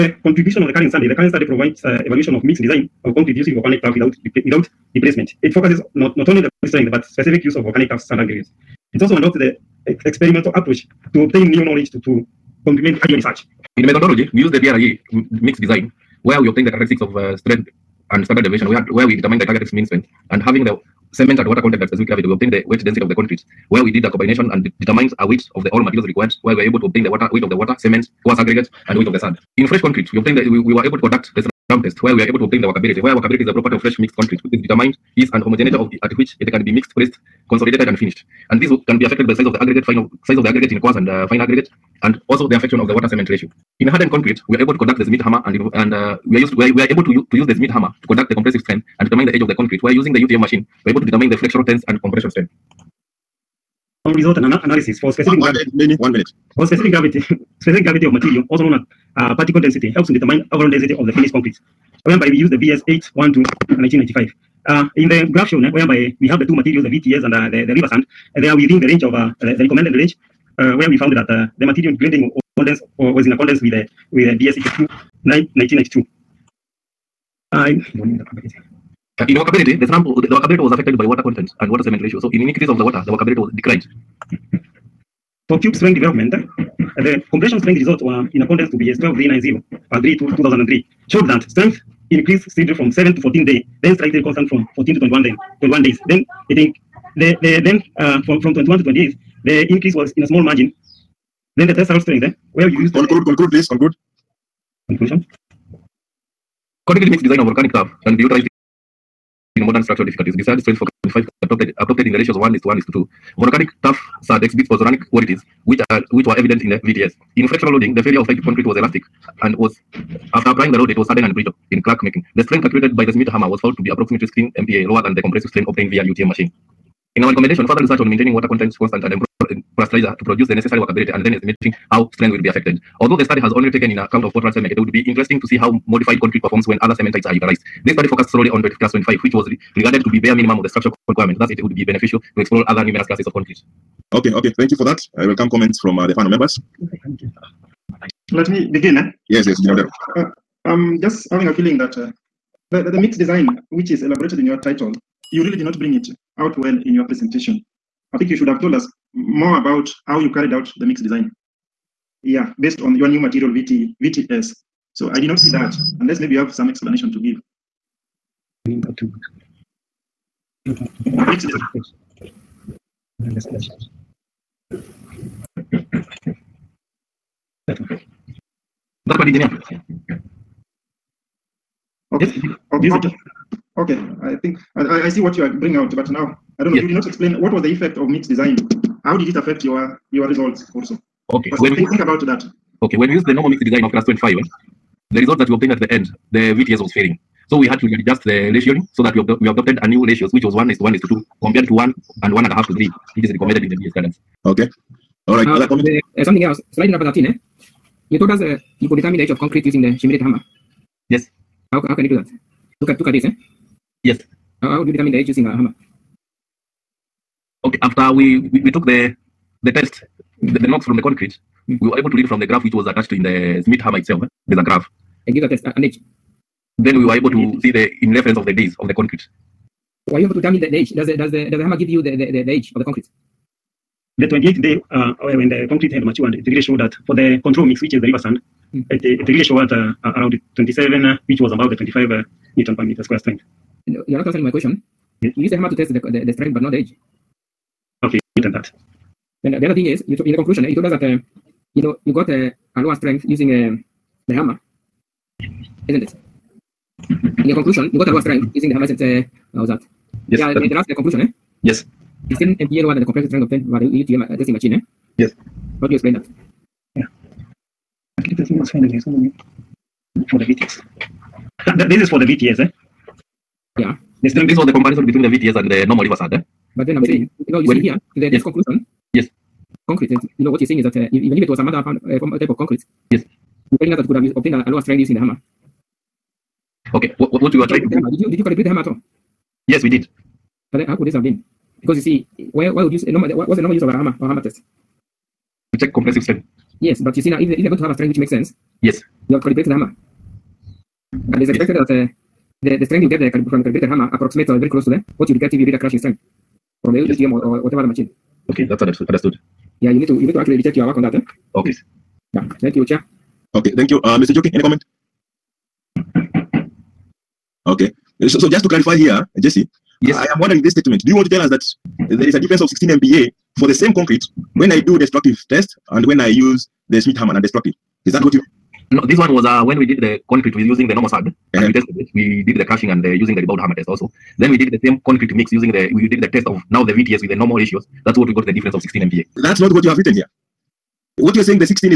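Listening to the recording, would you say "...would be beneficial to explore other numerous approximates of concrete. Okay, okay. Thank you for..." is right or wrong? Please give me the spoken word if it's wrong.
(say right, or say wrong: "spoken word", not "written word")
wrong: "classes", not "approximates".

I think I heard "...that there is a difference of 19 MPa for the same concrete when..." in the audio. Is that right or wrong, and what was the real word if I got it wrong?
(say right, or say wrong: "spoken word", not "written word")
wrong: "16", not "19".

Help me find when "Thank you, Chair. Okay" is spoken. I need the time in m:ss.
5:12.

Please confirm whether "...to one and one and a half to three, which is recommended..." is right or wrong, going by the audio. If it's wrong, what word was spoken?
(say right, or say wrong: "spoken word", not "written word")
right.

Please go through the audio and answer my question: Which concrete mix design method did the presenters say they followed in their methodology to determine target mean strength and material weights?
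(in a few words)
BRE.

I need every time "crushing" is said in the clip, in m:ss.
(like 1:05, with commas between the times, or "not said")
5:05, 5:32.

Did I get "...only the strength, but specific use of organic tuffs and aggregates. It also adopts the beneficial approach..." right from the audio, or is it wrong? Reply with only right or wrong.
wrong.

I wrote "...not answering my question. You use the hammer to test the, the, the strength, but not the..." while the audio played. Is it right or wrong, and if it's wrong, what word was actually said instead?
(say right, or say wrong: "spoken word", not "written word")
right.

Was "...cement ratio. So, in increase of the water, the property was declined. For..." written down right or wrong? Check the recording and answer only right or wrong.
wrong.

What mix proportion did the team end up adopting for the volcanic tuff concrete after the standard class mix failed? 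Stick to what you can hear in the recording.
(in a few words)
1:1:2.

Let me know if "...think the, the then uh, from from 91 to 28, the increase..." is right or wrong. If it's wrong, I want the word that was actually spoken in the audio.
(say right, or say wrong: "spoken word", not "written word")
wrong: "21", not "91".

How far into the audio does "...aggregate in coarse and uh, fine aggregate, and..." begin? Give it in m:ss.
0:40.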